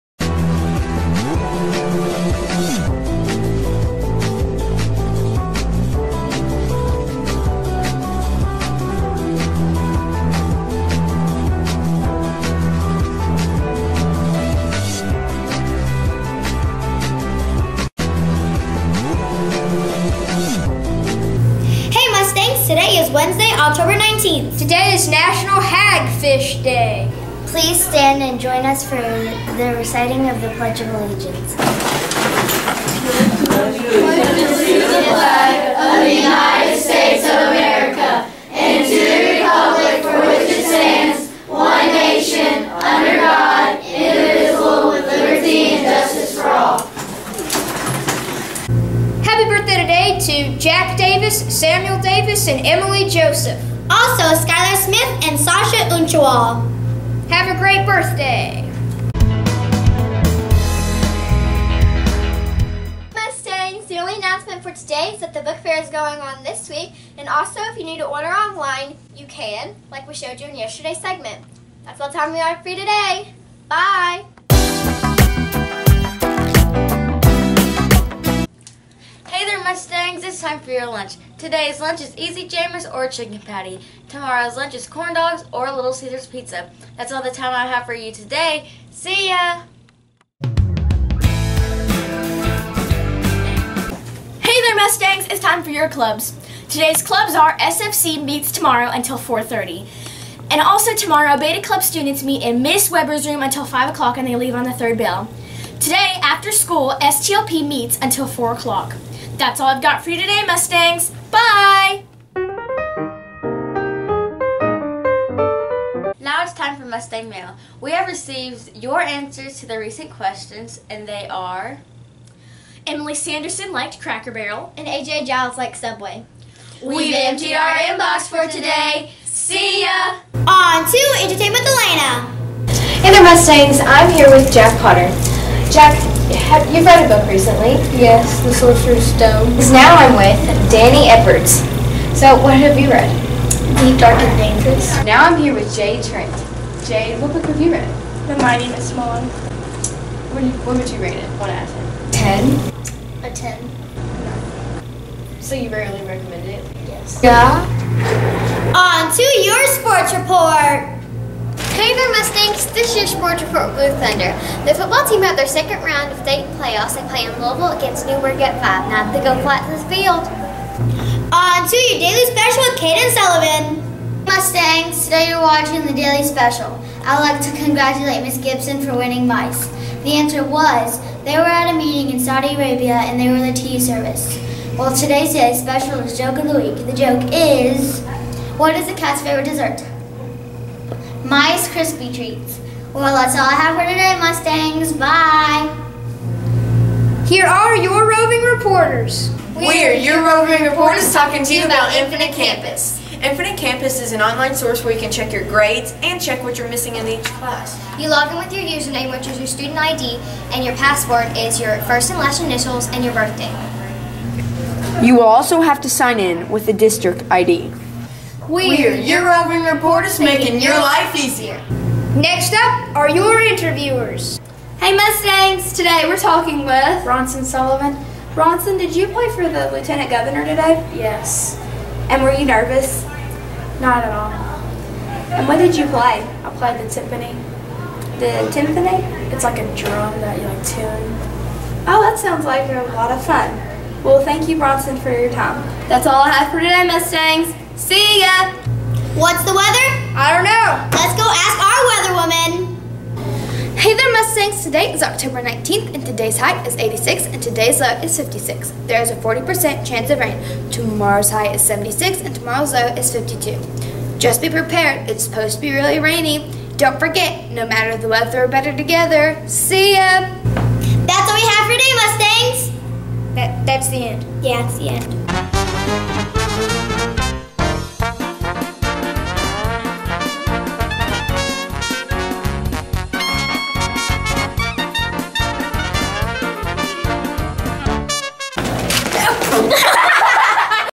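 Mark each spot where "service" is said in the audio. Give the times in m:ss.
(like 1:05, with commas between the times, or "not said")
3:03.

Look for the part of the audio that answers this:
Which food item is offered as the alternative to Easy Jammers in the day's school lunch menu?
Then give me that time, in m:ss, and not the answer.
1:23.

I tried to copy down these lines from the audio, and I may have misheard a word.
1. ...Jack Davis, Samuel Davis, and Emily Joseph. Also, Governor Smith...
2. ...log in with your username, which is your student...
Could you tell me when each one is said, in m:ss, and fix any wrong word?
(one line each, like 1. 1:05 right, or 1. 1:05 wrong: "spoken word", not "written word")
1. 0:50 wrong: "Skylar", not "Governor"
2. 3:28 right.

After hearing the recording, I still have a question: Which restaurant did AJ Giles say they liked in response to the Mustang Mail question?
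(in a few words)
Subway.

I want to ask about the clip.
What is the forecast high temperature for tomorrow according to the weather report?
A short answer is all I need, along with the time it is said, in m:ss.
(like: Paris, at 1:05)
76, at 4:21.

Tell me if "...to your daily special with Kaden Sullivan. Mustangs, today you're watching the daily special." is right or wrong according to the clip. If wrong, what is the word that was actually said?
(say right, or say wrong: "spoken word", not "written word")
right.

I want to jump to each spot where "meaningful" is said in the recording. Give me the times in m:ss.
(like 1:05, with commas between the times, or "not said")
not said.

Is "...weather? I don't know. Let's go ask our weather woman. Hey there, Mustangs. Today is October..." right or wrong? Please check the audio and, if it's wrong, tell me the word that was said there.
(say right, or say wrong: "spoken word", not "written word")
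right.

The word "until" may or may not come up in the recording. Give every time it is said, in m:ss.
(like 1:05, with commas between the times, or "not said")
1:38, 1:43, 1:48.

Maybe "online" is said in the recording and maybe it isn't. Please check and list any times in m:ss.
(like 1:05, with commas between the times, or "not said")
1:08, 3:24.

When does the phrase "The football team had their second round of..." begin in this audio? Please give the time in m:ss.
2:44.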